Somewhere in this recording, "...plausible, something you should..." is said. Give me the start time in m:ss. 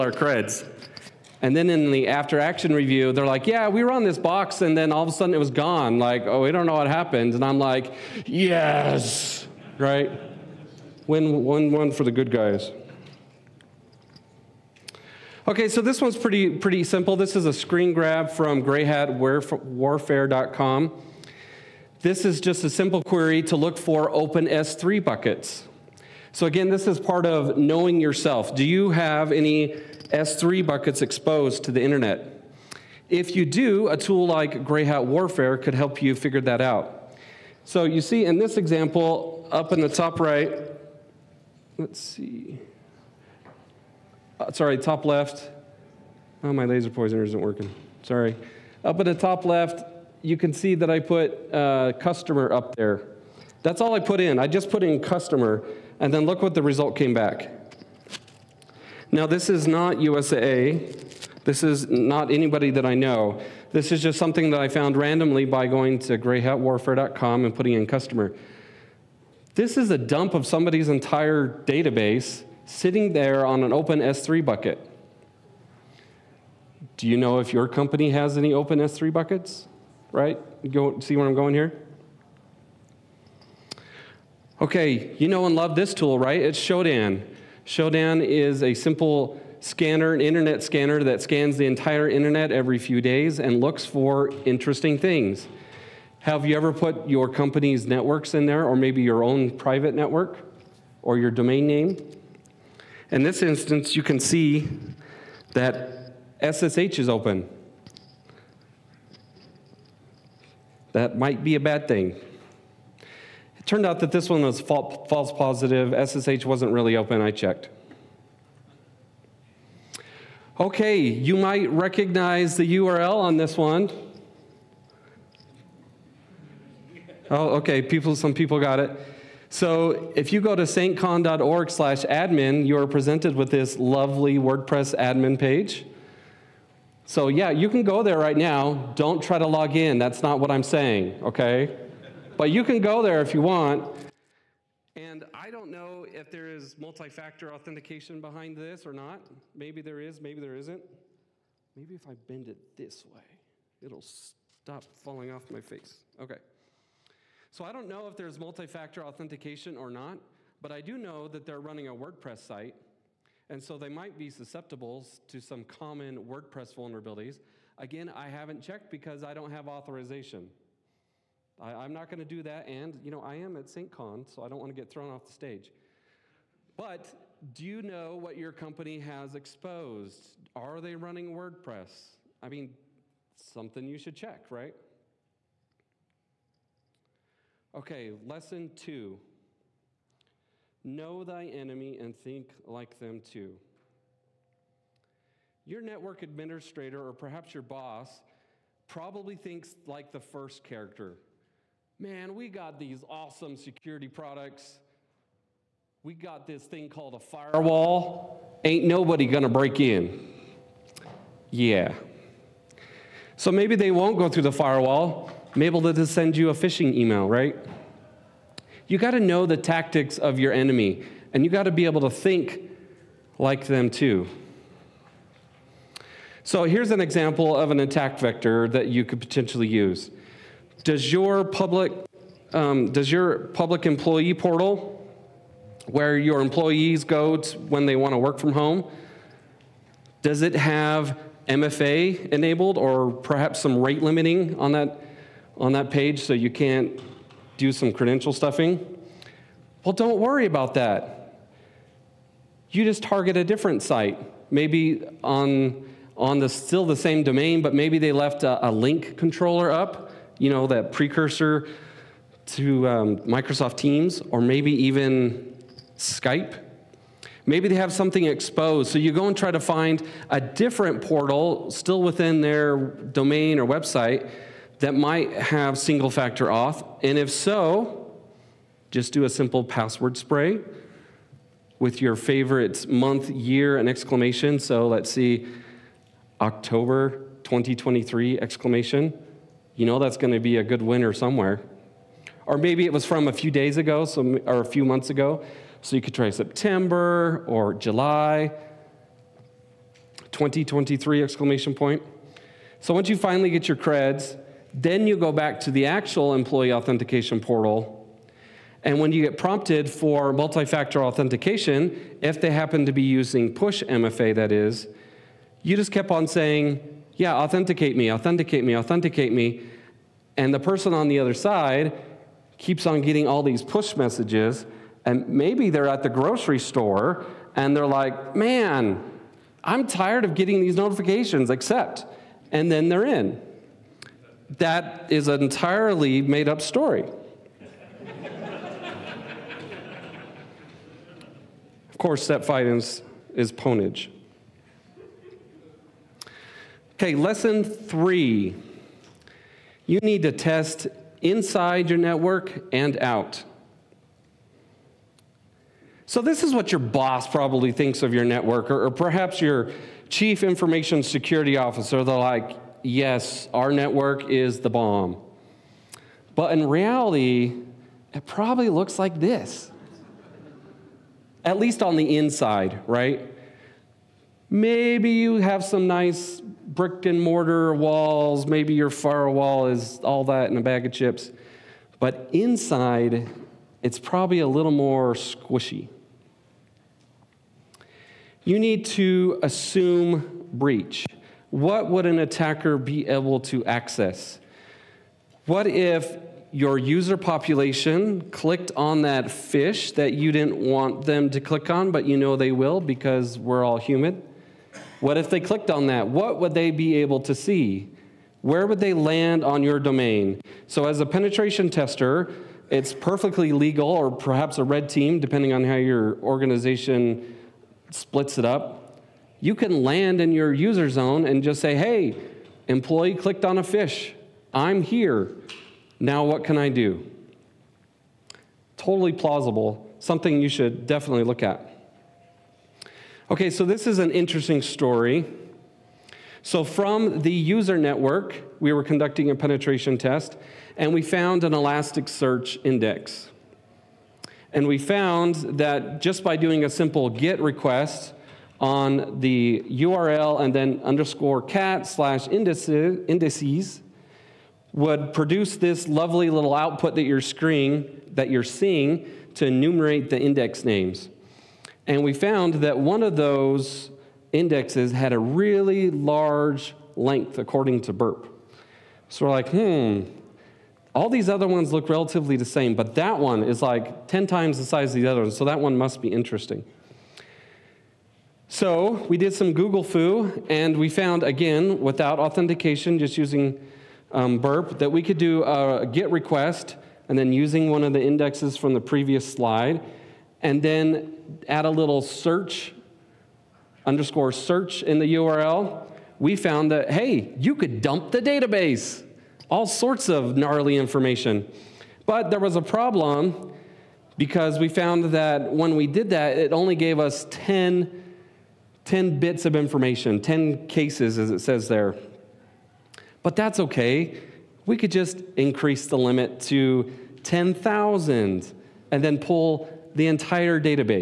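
7:09.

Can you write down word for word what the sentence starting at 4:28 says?
So you go and try to find a different portal still within their domain or website that might have single factor auth?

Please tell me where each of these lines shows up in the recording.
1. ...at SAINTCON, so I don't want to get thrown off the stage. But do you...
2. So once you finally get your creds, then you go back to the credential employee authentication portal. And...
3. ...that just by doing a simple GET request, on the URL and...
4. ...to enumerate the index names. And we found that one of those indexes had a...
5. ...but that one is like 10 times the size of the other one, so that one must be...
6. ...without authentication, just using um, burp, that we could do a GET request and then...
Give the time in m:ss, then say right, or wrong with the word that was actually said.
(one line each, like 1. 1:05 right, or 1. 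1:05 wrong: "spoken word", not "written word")
1. 2:53 right
2. 5:02 wrong: "actual", not "credential"
3. 7:25 right
4. 7:39 right
5. 7:52 right
6. 8:01 right.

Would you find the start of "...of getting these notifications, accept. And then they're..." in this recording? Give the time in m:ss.
5:30.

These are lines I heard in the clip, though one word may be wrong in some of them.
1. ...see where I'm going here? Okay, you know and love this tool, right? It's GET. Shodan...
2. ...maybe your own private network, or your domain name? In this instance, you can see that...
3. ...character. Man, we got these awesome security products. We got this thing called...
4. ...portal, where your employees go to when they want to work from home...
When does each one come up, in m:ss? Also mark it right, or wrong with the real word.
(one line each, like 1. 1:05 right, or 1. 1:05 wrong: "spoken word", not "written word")
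1. 1:21 wrong: "Shodan", not "GET"
2. 1:38 right
3. 3:20 right
4. 3:54 right.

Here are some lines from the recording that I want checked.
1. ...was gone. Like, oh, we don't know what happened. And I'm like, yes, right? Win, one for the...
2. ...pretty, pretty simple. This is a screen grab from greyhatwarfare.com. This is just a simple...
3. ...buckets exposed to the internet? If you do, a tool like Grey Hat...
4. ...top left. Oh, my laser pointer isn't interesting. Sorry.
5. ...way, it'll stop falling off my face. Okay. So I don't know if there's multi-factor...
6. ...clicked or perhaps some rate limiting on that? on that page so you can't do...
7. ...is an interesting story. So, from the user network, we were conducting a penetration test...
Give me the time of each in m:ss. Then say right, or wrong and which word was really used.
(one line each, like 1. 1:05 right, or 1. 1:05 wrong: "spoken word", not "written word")
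1. 0:05 right
2. 0:16 right
3. 0:30 right
4. 0:44 wrong: "working", not "interesting"
5. 2:33 right
6. 4:02 wrong: "enabled", not "clicked"
7. 7:13 right.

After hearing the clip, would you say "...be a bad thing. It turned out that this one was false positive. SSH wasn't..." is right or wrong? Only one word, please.
right.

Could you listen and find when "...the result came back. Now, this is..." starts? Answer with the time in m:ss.
0:56.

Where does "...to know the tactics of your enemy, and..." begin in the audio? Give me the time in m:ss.
3:39.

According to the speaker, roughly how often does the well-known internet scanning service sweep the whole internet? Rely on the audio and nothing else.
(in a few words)
every few days.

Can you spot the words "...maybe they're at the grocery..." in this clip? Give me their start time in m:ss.
5:25.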